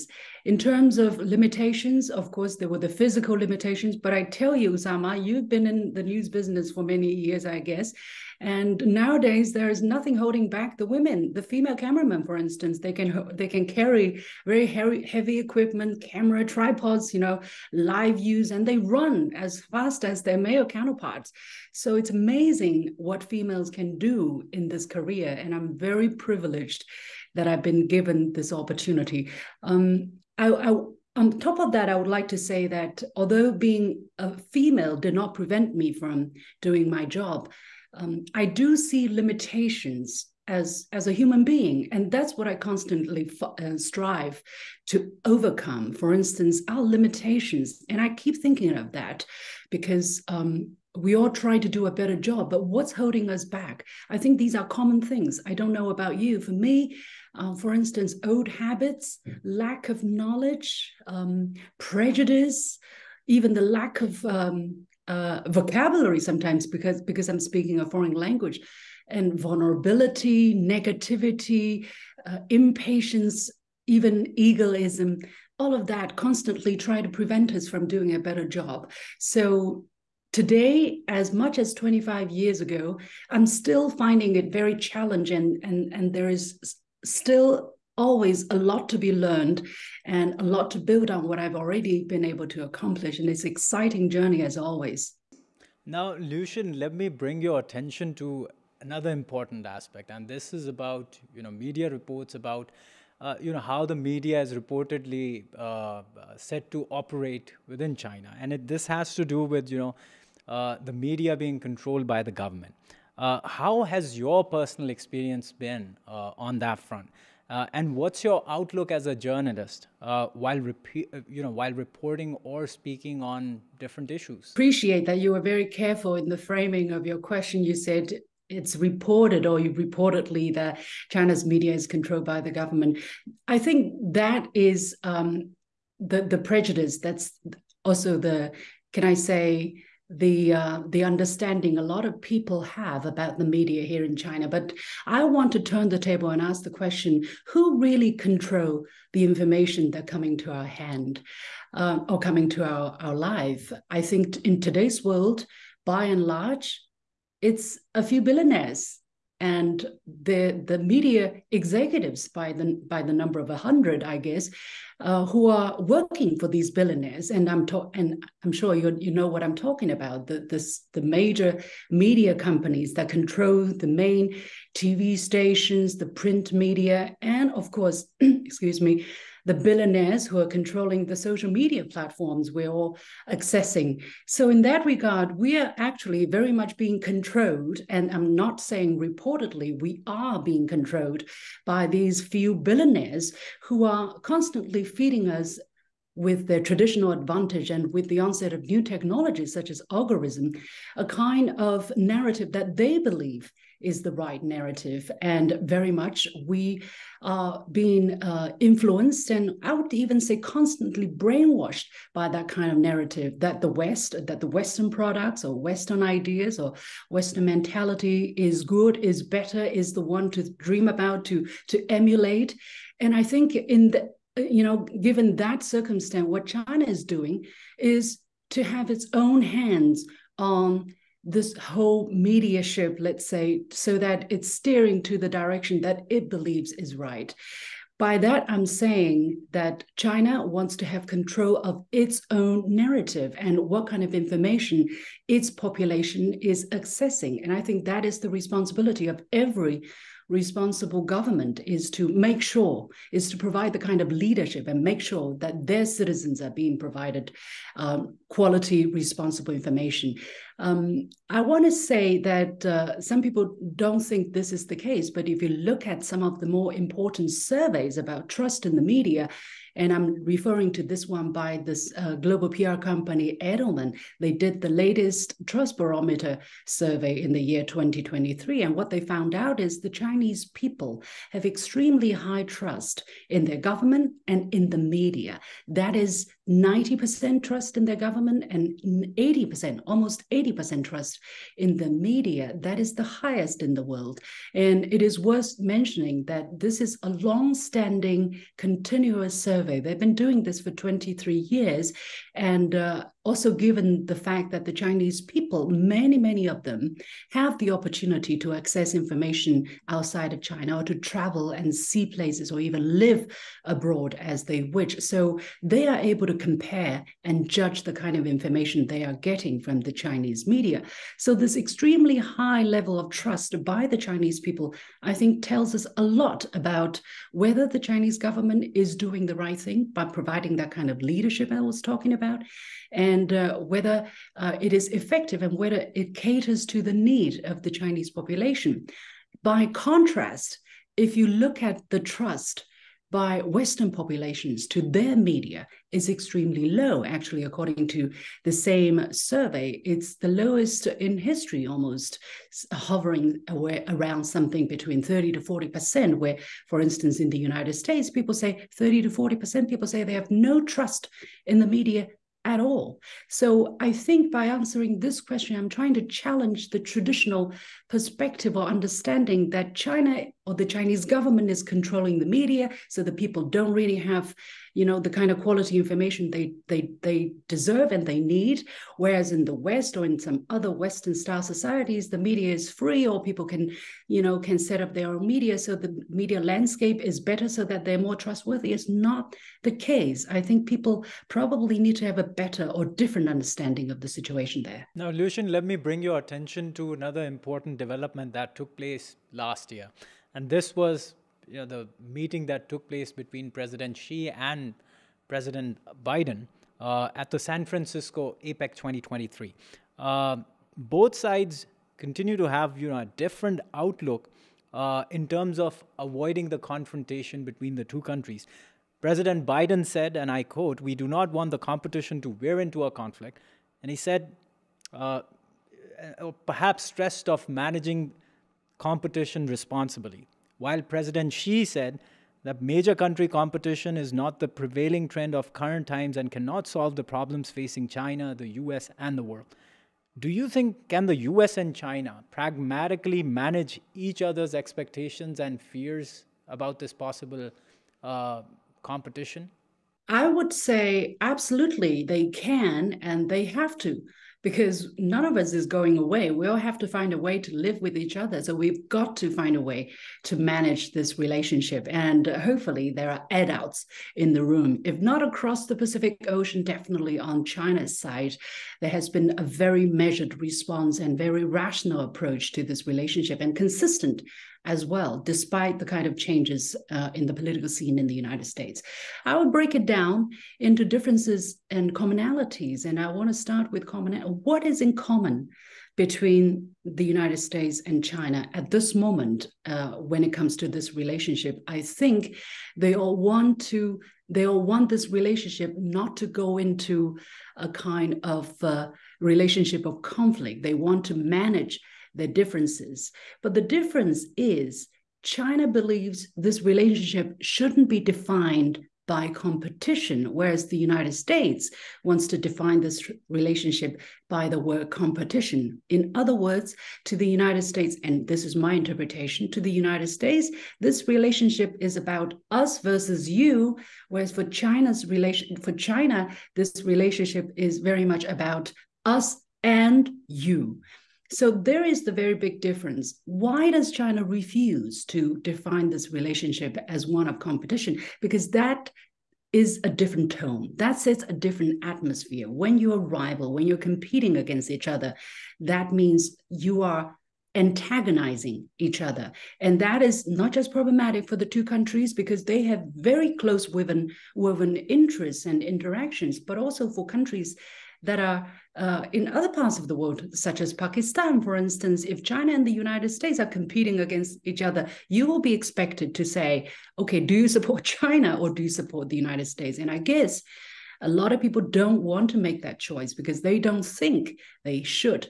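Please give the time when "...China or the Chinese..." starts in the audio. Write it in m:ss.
6:09.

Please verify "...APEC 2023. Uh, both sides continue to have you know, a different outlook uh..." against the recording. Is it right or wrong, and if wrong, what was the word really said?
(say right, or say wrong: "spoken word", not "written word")
right.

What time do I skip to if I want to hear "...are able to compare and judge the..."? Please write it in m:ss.
5:15.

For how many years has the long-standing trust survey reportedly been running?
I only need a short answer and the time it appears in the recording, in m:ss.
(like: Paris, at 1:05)
23 years, at 5:00.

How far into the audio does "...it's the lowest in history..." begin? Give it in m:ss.
5:49.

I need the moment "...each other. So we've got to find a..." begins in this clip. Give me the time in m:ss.
7:37.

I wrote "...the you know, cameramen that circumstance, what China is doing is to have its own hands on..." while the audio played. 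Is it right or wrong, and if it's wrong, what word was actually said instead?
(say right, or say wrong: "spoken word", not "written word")
wrong: "given", not "cameramen".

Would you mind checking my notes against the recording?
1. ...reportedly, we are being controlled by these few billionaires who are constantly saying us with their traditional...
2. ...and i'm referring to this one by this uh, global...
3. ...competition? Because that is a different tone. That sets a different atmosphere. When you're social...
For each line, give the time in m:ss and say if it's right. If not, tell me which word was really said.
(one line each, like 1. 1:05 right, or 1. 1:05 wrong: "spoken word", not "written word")
1. 3:08 wrong: "feeding", not "saying"
2. 4:29 right
3. 8:57 wrong: "rival", not "social".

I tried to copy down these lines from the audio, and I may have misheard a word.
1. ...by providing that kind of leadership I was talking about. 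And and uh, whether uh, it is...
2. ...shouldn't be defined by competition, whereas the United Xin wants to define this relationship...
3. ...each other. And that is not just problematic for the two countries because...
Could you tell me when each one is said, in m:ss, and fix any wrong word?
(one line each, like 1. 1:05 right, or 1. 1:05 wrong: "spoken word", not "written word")
1. 5:29 right
2. 8:27 wrong: "States", not "Xin"
3. 9:08 right.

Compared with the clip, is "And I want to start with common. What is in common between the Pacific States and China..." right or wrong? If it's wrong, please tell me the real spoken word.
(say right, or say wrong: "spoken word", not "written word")
wrong: "United", not "Pacific".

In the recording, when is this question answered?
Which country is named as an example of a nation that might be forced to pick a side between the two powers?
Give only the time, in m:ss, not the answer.
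9:20.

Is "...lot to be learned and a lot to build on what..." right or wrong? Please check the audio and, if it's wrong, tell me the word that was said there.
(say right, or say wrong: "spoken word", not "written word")
right.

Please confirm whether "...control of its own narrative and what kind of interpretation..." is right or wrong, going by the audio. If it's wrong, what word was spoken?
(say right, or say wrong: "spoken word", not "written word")
wrong: "information", not "interpretation".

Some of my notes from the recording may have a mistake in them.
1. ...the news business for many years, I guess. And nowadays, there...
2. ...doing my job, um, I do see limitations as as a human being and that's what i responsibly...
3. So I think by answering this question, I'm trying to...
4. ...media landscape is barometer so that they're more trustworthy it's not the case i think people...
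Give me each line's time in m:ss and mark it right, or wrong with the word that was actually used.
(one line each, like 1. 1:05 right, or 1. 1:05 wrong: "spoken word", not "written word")
1. 0:05 right
2. 0:36 wrong: "constantly", not "responsibly"
3. 6:03 right
4. 6:26 wrong: "better", not "barometer".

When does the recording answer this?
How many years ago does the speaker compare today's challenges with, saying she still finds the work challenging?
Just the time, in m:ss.
1:21.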